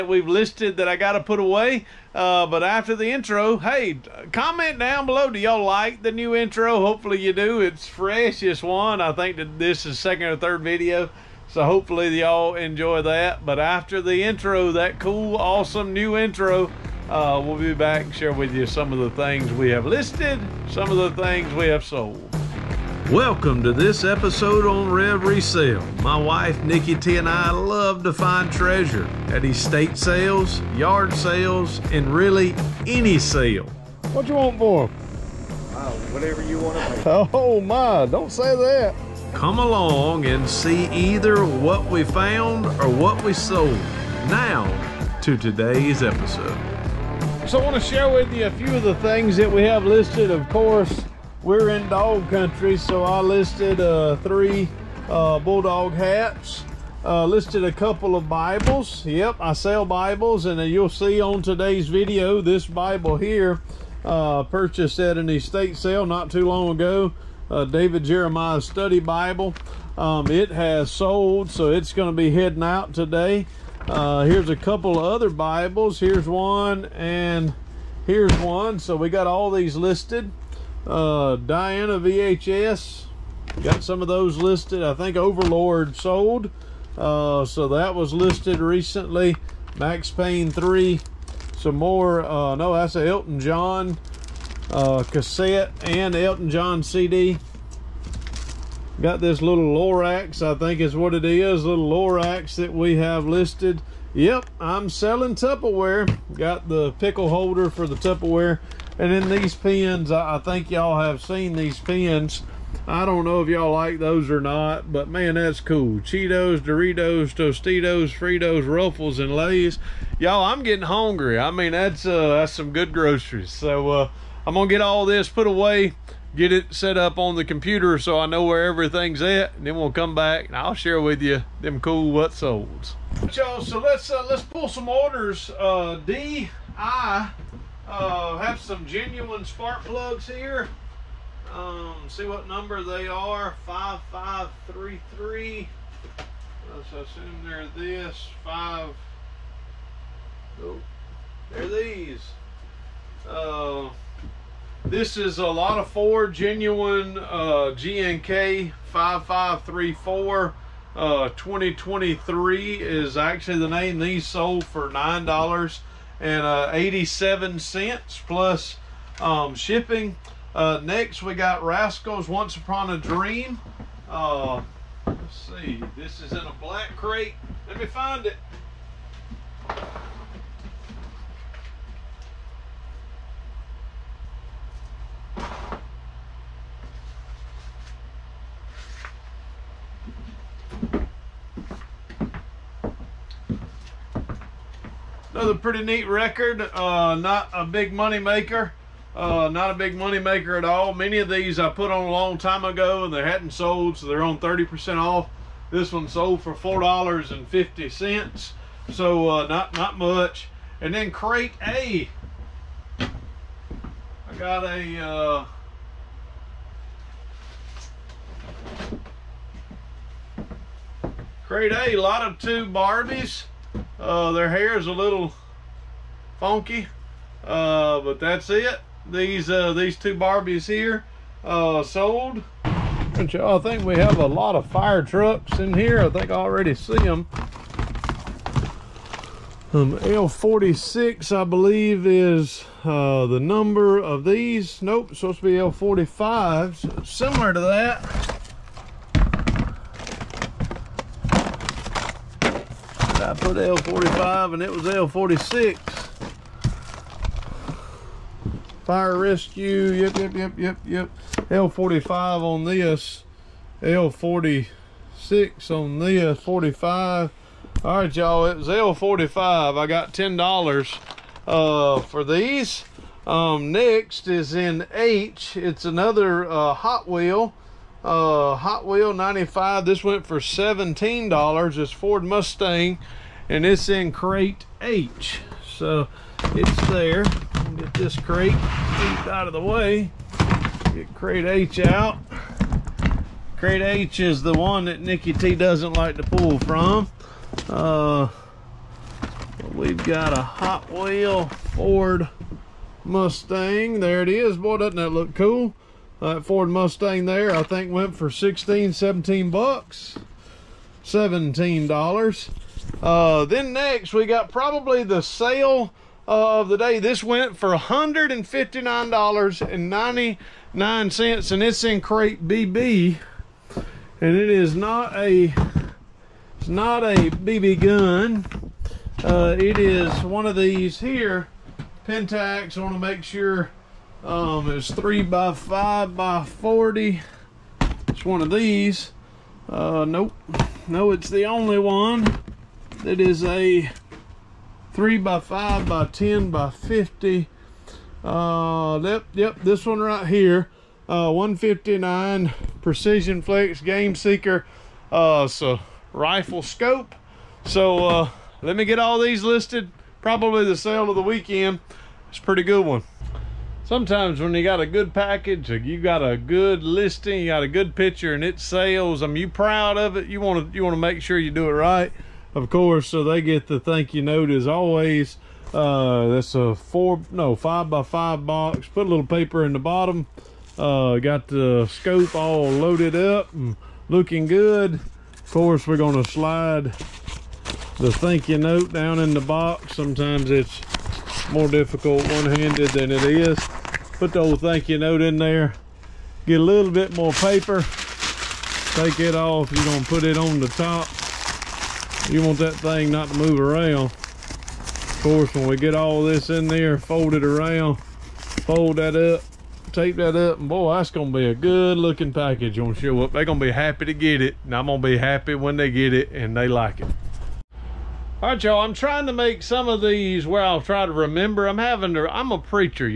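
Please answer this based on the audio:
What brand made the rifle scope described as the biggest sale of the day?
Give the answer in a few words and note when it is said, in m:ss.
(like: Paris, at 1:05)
Pentax, at 5:32.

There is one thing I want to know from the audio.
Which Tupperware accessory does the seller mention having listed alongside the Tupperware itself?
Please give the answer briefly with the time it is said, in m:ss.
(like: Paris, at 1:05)
pickle holder, at 1:46.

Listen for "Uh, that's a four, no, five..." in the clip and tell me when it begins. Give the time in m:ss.
6:15.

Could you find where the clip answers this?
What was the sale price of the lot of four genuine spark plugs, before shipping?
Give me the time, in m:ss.
2:44.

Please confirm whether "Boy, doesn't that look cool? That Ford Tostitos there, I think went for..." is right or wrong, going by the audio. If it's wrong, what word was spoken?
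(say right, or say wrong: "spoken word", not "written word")
wrong: "Mustang", not "Tostitos".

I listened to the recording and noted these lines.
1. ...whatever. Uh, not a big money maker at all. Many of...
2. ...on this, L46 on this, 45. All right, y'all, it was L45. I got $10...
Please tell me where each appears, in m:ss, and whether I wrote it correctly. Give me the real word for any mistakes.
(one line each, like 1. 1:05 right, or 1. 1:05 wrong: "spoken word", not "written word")
1. 3:18 wrong: "maker", not "whatever"
2. 4:22 right.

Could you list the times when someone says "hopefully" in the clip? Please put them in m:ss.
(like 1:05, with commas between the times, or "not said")
0:06, 0:11.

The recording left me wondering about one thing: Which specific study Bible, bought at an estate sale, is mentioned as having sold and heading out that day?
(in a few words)
David Jeremiah Study Bible.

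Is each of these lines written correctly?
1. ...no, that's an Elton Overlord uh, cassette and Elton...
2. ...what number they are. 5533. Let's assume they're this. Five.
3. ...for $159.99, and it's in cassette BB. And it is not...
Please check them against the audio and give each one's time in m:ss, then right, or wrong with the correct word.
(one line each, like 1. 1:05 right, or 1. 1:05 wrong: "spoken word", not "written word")
1. 1:32 wrong: "John", not "Overlord"
2. 2:22 right
3. 5:17 wrong: "crate", not "cassette".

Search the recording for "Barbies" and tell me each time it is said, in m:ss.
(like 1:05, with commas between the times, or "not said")
3:42, 3:50.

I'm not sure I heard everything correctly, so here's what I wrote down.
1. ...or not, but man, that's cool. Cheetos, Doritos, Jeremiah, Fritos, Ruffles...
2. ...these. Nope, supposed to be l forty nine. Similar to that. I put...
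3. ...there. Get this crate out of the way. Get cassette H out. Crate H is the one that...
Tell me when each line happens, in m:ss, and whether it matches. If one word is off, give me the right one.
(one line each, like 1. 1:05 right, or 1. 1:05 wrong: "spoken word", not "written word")
1. 1:54 wrong: "Tostitos", not "Jeremiah"
2. 4:04 wrong: "five", not "nine"
3. 4:46 wrong: "crate", not "cassette".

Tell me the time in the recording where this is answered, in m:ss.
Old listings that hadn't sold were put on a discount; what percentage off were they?
3:24.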